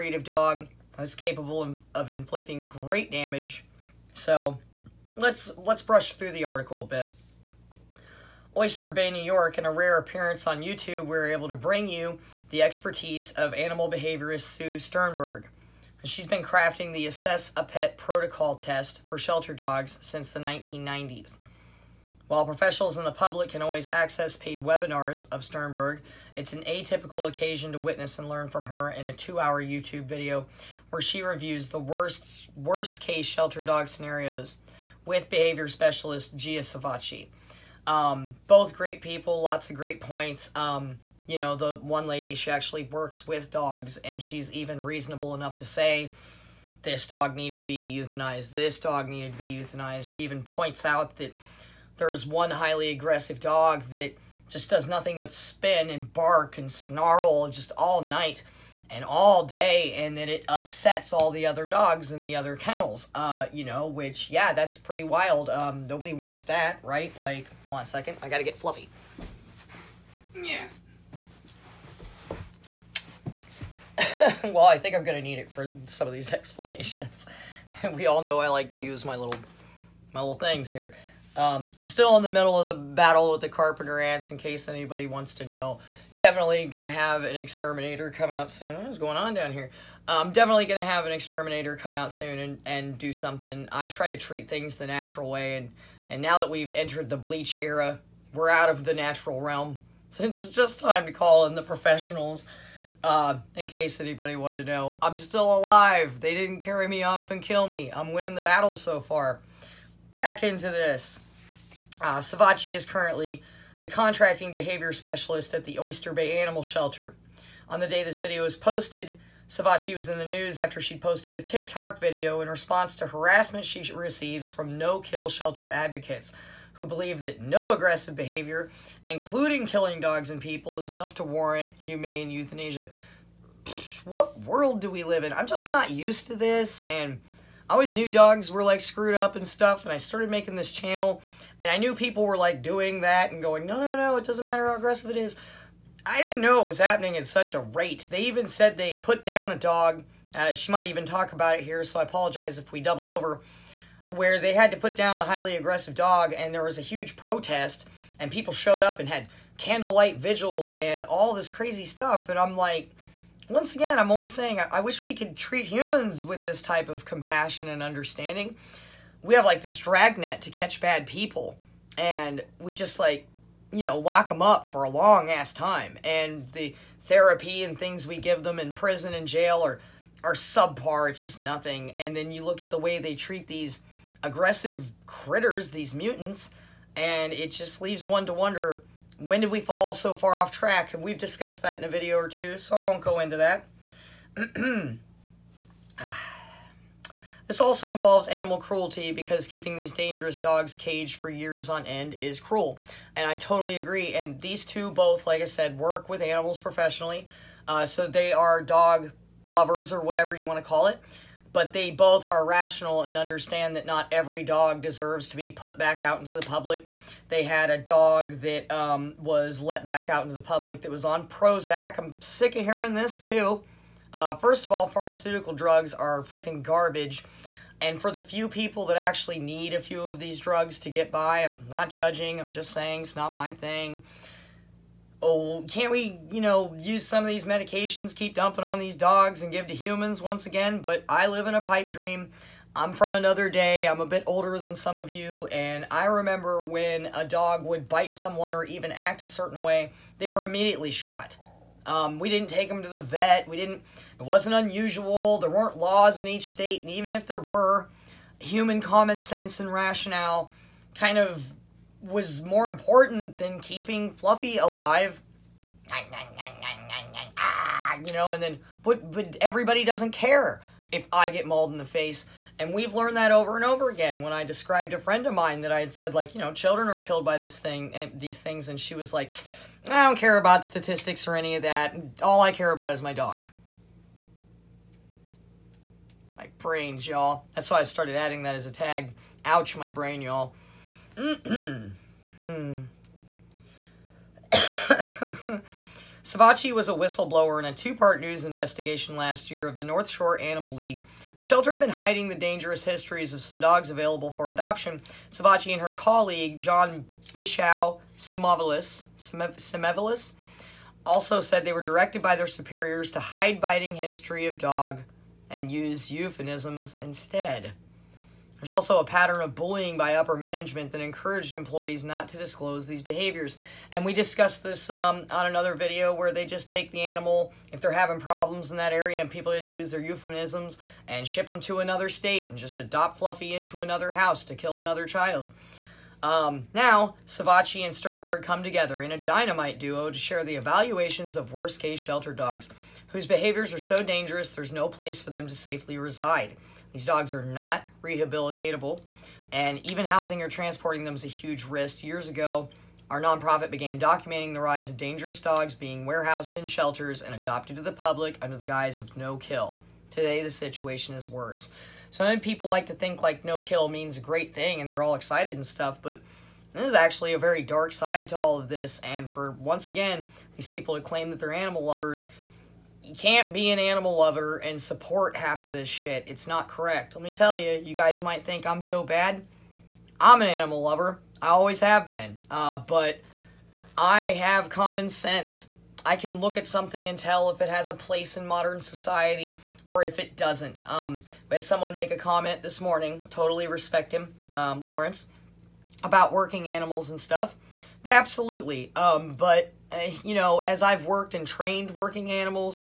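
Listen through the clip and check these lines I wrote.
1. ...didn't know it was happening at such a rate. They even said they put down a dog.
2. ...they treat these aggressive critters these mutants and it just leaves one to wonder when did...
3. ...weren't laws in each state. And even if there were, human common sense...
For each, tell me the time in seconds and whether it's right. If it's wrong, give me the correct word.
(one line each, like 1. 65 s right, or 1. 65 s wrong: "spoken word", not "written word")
1. 146 s right
2. 182 s right
3. 255 s right.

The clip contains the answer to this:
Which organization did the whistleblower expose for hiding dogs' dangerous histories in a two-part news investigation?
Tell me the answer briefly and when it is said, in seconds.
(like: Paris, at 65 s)
North Shore Animal League, at 299 s.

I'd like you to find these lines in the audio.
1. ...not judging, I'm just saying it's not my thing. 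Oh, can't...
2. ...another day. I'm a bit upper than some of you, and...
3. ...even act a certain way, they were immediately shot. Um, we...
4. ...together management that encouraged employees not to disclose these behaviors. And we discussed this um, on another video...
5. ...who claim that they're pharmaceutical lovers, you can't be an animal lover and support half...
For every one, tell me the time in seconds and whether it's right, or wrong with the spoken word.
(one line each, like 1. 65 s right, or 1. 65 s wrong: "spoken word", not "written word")
1. 231 s right
2. 243 s wrong: "older", not "upper"
3. 248 s right
4. 320 s wrong: "upper", not "together"
5. 370 s wrong: "animal", not "pharmaceutical".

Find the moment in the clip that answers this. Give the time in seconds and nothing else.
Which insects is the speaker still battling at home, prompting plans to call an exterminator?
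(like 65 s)
83 s.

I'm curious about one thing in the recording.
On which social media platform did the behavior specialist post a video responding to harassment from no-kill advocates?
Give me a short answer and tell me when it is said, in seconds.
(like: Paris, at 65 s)
TikTok, at 121 s.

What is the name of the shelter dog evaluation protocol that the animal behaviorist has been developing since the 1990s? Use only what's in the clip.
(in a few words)
Assess a Pet.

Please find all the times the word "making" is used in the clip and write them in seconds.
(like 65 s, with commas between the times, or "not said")
140 s.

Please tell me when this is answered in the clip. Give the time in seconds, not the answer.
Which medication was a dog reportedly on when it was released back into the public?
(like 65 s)
221 s.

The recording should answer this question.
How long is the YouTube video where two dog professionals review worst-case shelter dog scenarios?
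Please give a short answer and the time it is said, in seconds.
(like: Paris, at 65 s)
two hour, at 29 s.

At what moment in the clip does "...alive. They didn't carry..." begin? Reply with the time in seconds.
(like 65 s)
105 s.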